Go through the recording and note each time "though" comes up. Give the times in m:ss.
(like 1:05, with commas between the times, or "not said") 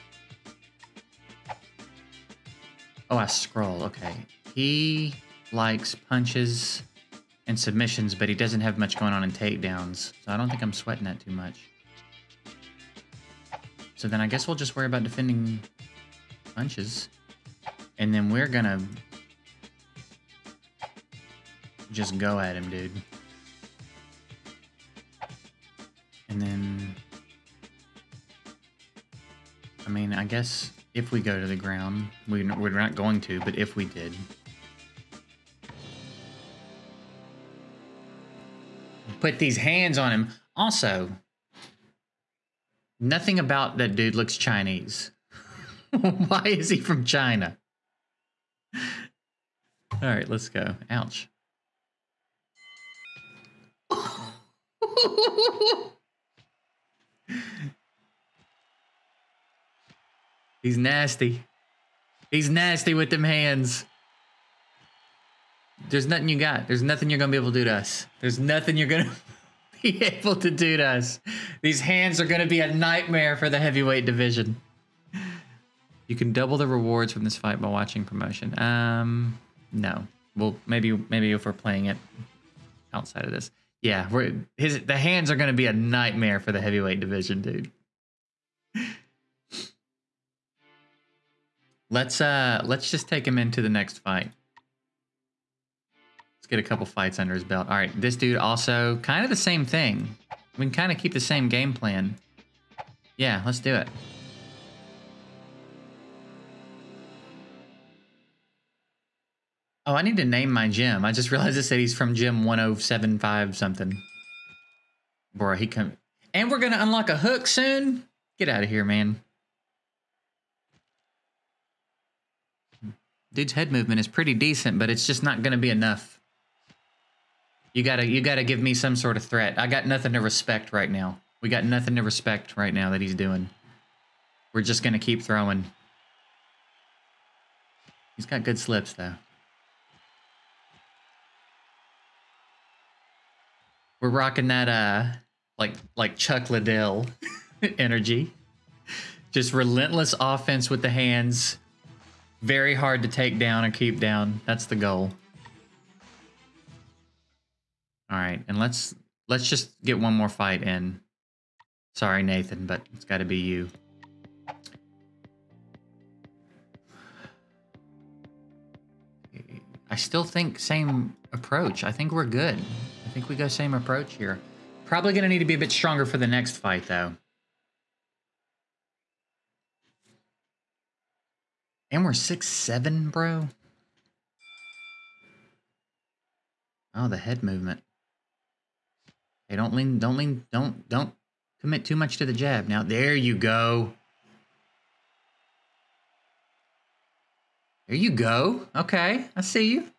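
2:18, 2:56.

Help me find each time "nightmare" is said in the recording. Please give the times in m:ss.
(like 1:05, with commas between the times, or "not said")
1:12, 1:25.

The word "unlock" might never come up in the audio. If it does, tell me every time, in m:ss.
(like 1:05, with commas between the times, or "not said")
1:56.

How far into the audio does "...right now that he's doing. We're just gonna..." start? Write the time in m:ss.
2:12.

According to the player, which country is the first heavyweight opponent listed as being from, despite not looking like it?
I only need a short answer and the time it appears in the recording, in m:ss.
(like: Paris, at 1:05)
China, at 0:47.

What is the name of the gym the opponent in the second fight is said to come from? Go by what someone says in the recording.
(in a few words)
gym 1075.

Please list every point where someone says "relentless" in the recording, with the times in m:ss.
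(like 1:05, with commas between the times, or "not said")
2:29.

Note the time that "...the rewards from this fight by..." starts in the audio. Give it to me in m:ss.
1:16.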